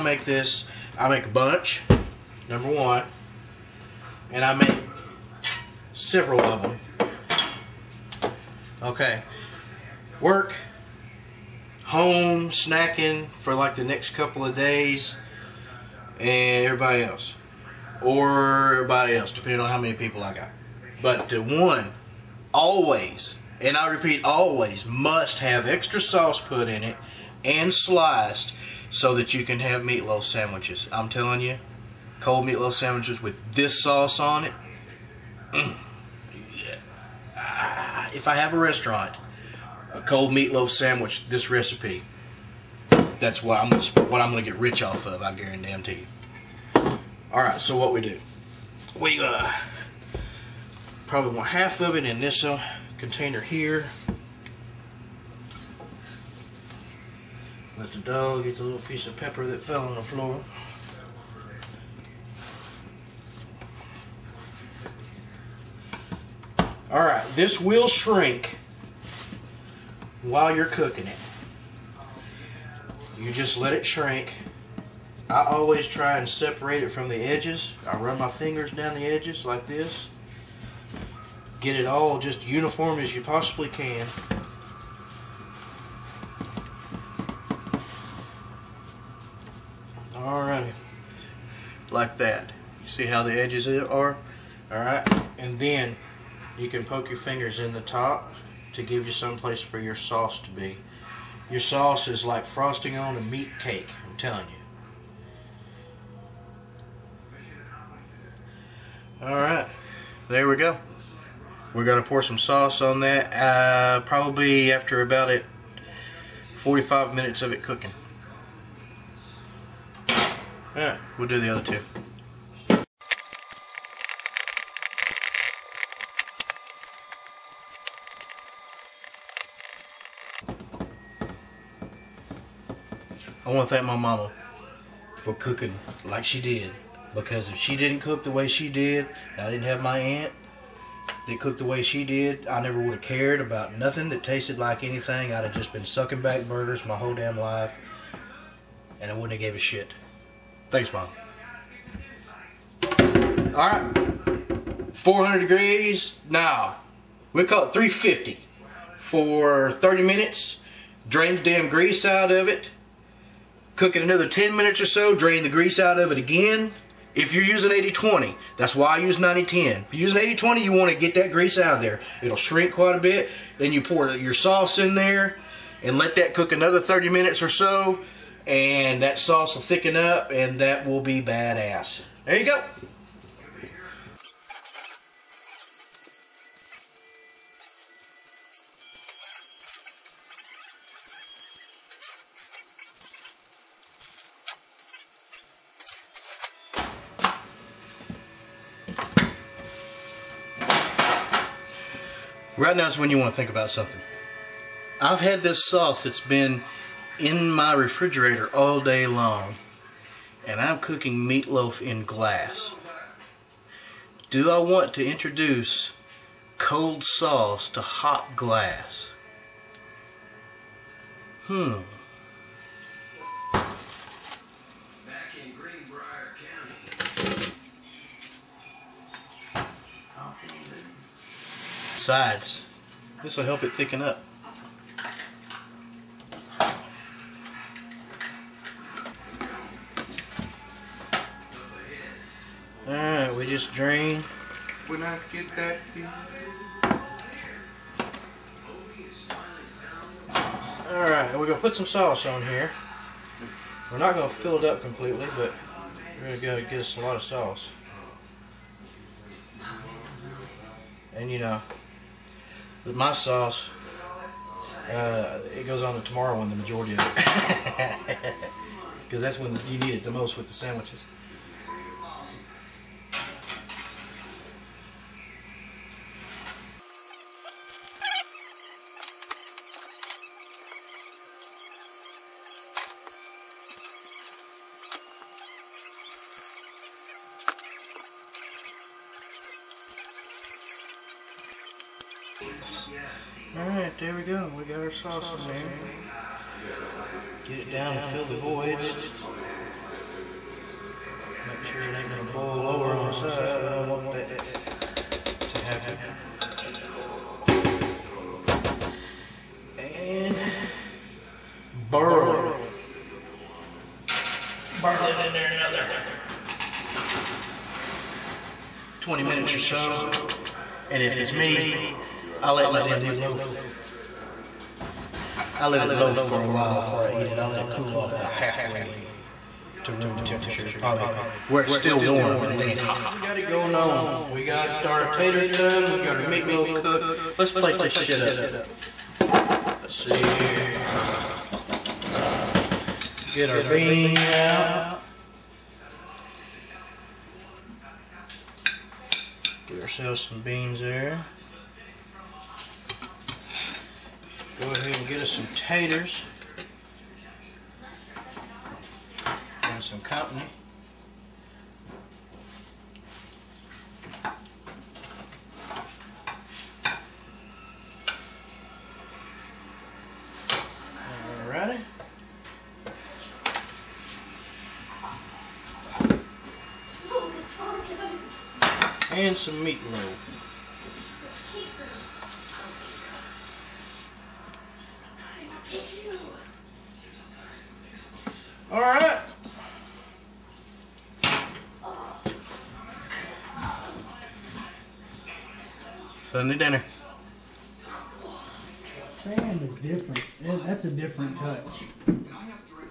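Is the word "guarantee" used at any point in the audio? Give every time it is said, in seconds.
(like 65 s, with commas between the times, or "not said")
45 s.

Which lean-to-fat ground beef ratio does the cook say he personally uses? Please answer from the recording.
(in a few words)
90-10.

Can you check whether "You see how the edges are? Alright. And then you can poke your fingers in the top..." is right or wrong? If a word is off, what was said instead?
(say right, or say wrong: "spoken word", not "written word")
right.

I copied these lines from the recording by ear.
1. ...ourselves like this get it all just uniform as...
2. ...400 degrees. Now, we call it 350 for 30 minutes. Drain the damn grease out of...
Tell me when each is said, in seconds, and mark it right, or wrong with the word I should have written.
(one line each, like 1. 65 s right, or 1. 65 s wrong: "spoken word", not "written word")
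1. 79 s wrong: "edges", not "ourselves"
2. 154 s right.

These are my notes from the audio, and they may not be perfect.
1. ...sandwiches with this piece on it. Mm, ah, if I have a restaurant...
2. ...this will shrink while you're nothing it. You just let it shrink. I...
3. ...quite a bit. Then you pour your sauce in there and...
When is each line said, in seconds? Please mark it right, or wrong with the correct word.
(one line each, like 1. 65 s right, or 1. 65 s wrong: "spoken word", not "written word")
1. 32 s wrong: "sauce", not "piece"
2. 67 s wrong: "cooking", not "nothing"
3. 172 s right.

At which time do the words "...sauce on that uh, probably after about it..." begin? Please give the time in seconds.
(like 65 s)
112 s.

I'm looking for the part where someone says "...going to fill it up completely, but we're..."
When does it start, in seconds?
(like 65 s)
254 s.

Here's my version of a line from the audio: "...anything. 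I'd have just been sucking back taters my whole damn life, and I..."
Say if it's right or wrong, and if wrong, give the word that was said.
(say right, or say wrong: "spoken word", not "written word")
wrong: "burgers", not "taters".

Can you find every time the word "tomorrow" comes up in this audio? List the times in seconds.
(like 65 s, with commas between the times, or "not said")
266 s.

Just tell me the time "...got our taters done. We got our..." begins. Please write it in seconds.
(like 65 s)
334 s.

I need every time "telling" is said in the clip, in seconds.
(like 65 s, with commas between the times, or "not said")
31 s, 104 s.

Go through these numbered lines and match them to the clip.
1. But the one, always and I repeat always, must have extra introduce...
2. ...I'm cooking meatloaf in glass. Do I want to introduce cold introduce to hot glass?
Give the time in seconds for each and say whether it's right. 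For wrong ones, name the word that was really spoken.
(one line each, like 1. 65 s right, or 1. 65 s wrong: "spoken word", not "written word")
1. 21 s wrong: "sauce", not "introduce"
2. 210 s wrong: "sauce", not "introduce".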